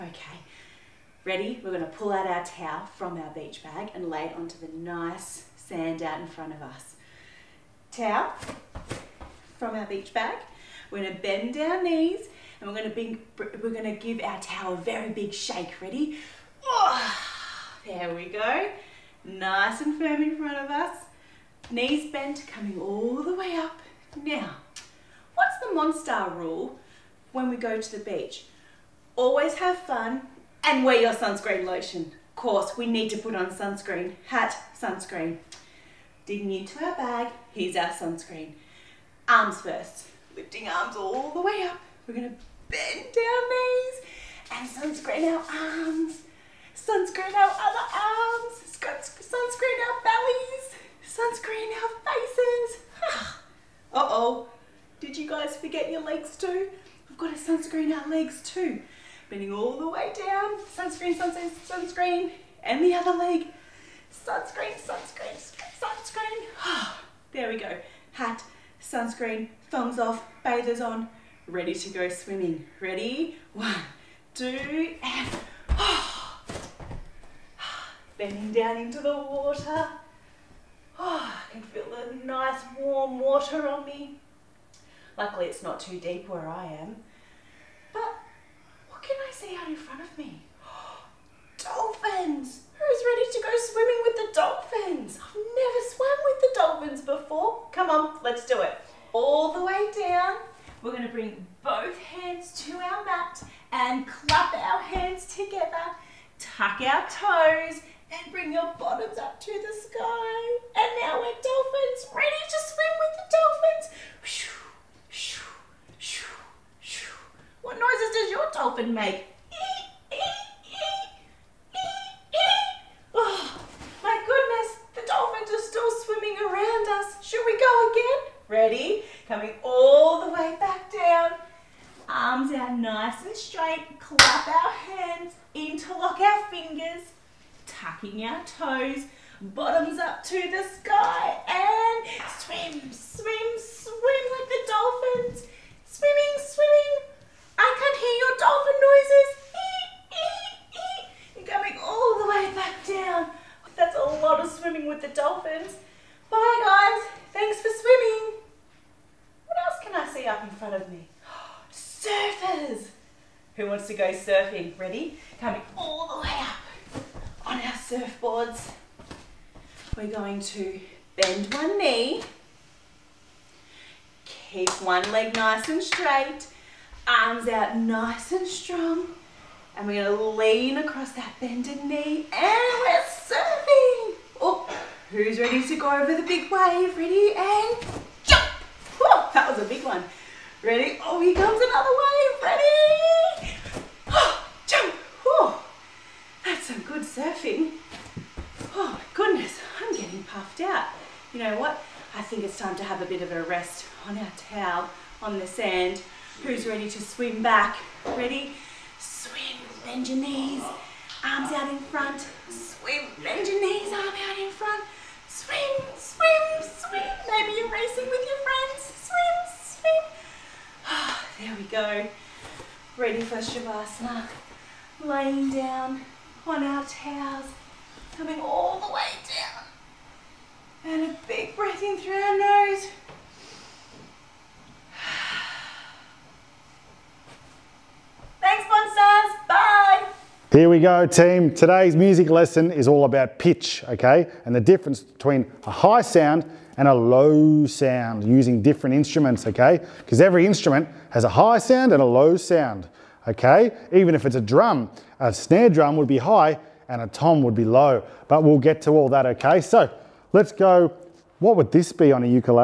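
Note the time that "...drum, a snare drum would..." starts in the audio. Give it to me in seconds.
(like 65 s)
254 s.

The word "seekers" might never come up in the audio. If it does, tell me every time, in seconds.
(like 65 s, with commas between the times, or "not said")
not said.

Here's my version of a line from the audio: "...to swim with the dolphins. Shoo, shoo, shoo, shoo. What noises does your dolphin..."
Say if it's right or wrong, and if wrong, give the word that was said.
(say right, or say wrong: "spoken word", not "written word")
right.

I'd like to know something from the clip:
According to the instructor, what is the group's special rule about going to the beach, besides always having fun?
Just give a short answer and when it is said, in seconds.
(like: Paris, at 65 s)
wear your sunscreen, at 30 s.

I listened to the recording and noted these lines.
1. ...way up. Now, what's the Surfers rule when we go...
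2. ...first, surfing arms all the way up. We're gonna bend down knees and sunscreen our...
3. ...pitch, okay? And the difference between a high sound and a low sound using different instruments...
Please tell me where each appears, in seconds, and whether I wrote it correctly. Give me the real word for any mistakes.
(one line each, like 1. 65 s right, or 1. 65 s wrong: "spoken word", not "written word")
1. 23 s wrong: "Monstar", not "Surfers"
2. 39 s wrong: "lifting", not "surfing"
3. 243 s right.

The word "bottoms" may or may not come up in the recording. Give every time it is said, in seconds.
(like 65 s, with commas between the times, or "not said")
108 s, 139 s.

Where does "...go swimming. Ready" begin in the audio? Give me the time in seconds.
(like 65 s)
71 s.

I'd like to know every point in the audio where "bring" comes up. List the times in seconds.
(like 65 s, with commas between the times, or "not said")
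12 s, 101 s, 108 s.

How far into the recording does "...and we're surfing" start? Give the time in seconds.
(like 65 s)
182 s.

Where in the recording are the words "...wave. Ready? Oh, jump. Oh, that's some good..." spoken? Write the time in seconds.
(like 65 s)
192 s.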